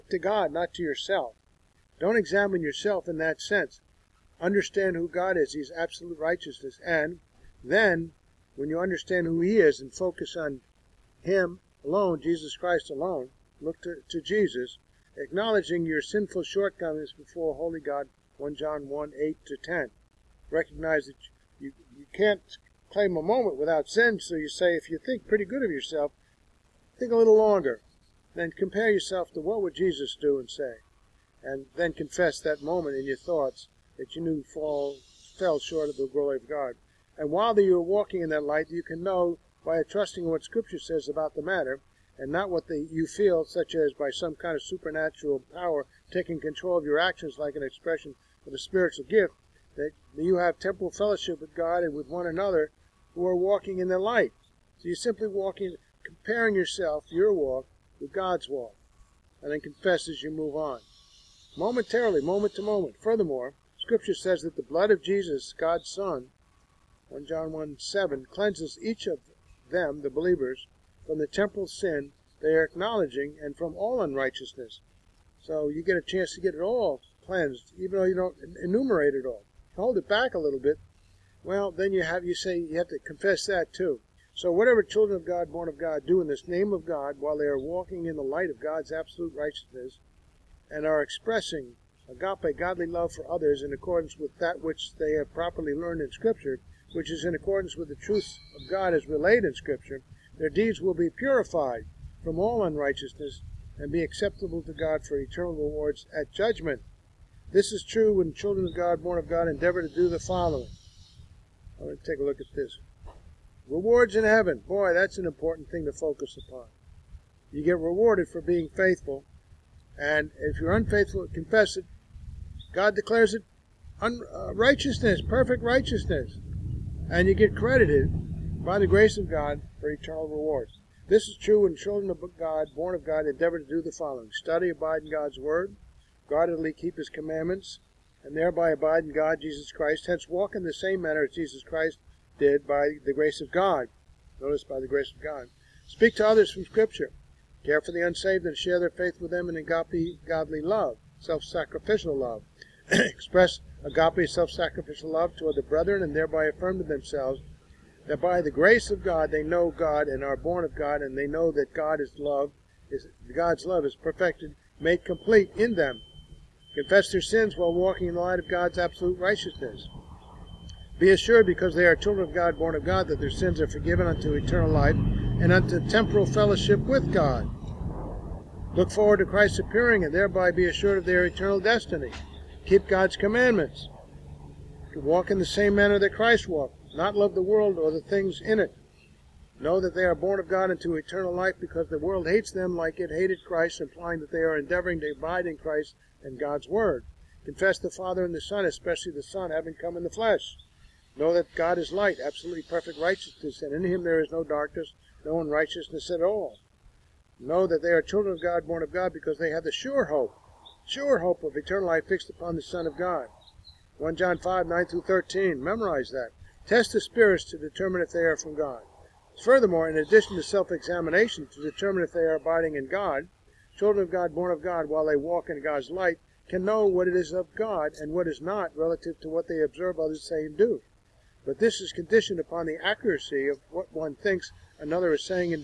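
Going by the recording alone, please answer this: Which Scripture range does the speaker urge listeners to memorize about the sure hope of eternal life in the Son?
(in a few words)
1 John 5:9-13.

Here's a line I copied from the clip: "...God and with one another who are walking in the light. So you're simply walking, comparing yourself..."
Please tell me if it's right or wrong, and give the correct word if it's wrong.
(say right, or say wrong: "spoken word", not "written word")
right.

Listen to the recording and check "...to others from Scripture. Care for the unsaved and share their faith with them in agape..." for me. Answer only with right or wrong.
right.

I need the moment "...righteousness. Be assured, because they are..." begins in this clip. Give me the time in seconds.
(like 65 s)
169 s.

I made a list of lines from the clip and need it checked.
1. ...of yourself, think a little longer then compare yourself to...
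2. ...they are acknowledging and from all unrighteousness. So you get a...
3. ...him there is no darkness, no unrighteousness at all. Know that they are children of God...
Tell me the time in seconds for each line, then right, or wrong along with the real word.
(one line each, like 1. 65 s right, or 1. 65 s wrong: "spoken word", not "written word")
1. 25 s right
2. 72 s right
3. 203 s right.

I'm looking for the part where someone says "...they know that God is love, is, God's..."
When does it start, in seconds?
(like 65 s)
161 s.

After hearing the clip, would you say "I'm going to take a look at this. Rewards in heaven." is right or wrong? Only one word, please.
right.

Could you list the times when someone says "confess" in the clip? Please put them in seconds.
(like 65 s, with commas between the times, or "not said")
31 s, 59 s, 82 s, 121 s, 166 s, 197 s.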